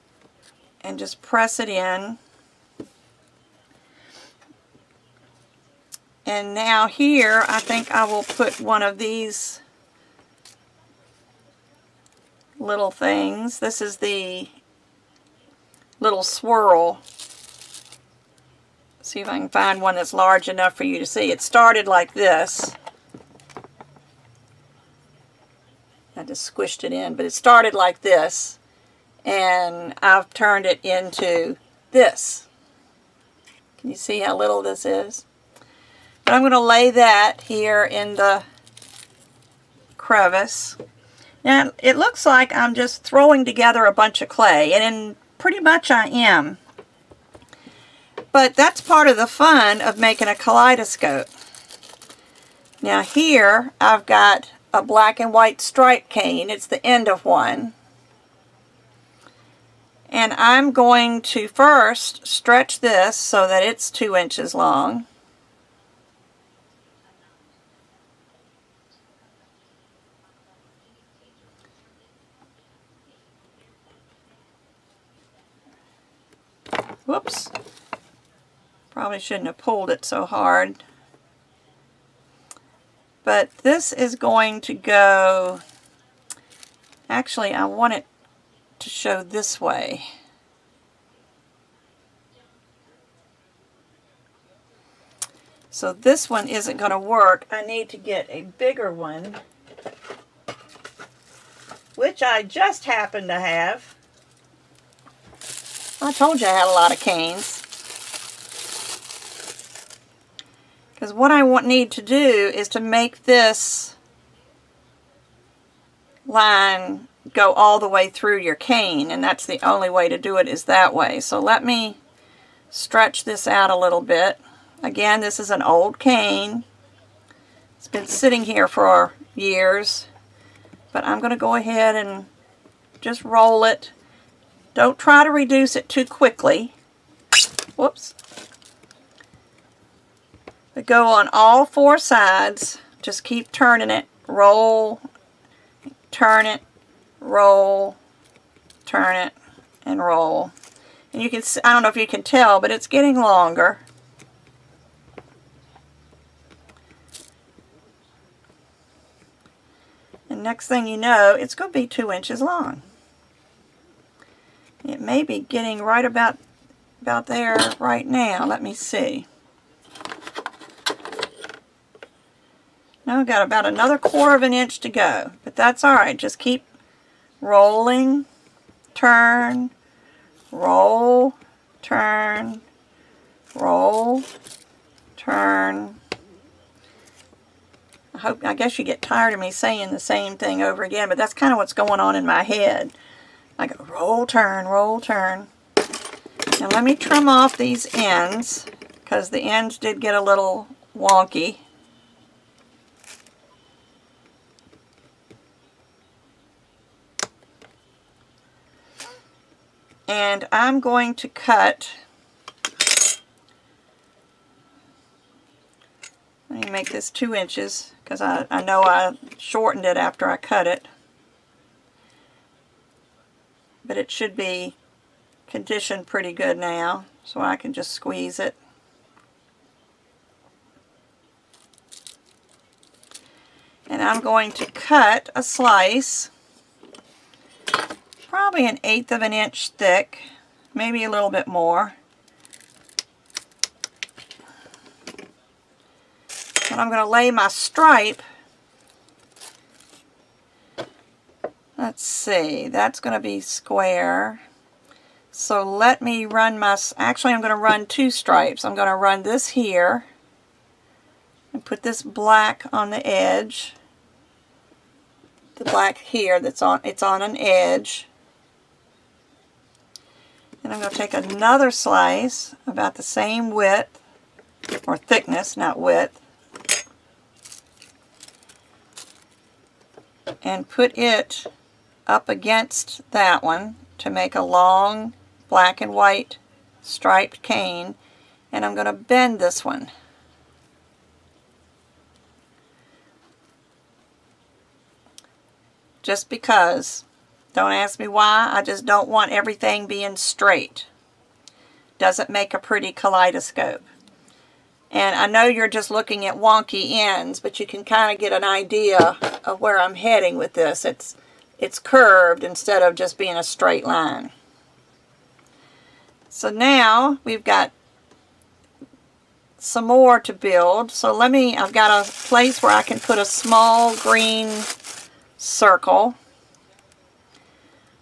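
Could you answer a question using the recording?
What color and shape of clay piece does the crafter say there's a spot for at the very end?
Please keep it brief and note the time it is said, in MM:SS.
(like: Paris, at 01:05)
small green circle, at 05:23.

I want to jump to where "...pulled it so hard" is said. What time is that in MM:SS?
01:19.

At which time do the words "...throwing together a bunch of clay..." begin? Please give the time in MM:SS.
00:43.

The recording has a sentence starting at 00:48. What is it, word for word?
But that's part of the fun of making a kaleidoscope.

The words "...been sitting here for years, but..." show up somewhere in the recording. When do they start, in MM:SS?
02:07.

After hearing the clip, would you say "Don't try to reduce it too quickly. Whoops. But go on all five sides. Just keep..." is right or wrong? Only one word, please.
wrong.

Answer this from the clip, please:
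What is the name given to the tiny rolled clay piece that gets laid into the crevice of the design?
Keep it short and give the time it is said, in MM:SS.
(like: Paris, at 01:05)
little swirl, at 00:13.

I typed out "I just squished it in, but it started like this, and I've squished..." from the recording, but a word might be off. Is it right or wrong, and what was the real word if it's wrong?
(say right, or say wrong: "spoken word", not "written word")
wrong: "turned", not "squished".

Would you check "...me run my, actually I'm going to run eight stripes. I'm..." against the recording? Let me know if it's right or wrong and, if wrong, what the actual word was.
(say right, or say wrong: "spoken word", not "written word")
wrong: "two", not "eight".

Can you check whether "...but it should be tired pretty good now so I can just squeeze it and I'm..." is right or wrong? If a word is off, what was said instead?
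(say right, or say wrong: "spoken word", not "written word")
wrong: "conditioned", not "tired".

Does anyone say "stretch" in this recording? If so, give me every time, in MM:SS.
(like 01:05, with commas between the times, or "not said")
01:02, 02:02.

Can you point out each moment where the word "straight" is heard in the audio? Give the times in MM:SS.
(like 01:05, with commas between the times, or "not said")
05:00, 05:13.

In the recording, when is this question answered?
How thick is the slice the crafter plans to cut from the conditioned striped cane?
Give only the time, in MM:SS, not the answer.
03:58.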